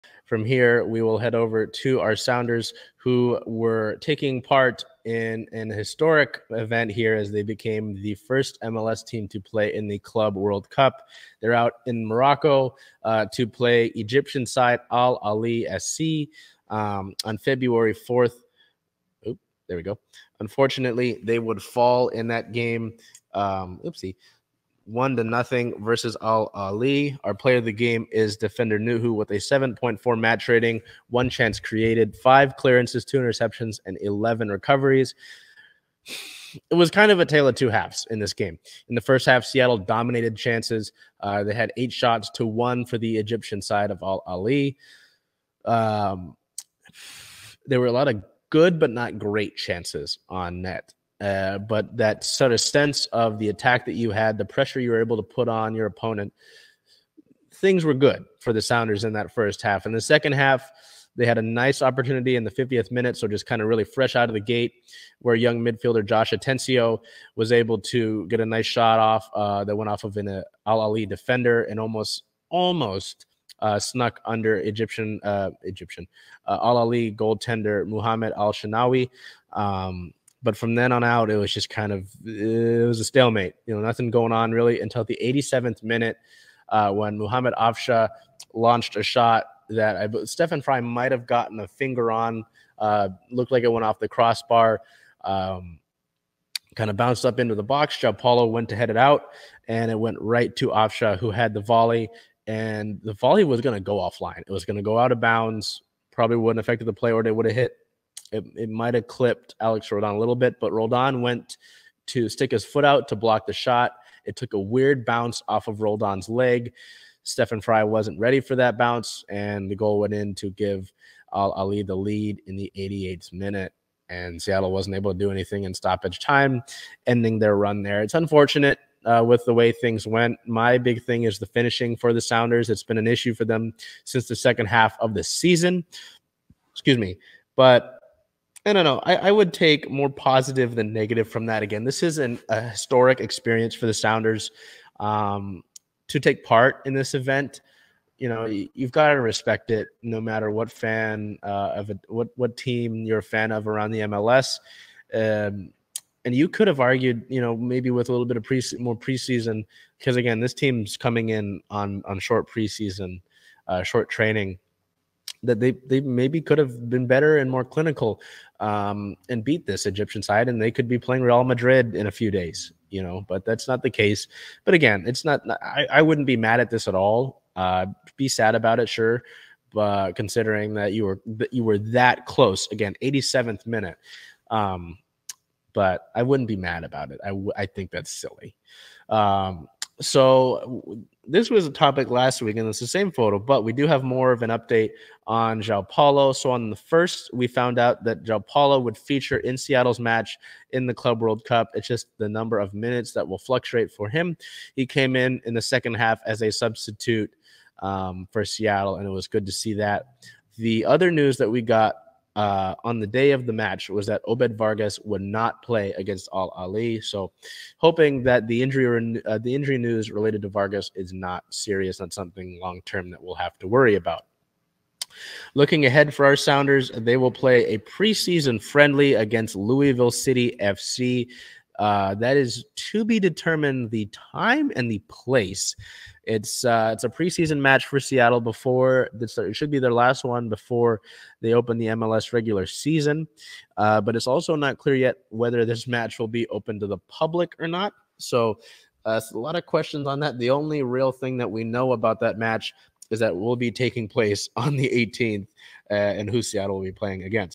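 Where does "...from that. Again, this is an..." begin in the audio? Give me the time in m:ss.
2:21.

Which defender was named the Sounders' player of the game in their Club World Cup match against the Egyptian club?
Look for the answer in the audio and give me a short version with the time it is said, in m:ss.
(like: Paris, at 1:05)
Nouhou, at 0:28.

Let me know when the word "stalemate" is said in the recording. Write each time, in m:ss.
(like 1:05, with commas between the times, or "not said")
1:23.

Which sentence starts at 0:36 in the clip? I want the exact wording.
It was kind of a tale of two halves in this game.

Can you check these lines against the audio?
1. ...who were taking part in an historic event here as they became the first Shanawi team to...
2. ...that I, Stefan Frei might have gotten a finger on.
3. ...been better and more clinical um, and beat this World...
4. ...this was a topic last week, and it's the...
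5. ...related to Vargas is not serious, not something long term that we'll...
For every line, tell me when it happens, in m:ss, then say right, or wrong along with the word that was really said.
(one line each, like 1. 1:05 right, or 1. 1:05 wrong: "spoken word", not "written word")
1. 0:02 wrong: "MLS", not "Shanawi"
2. 1:29 right
3. 2:46 wrong: "Egyptian", not "World"
4. 3:11 right
5. 3:40 right.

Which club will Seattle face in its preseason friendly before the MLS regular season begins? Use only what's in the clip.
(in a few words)
Louisville City FC.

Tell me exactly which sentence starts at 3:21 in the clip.
It's just the number of minutes that will fluctuate for him.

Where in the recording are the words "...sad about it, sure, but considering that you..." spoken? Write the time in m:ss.
2:58.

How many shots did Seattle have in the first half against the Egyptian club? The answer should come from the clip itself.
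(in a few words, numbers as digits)
8.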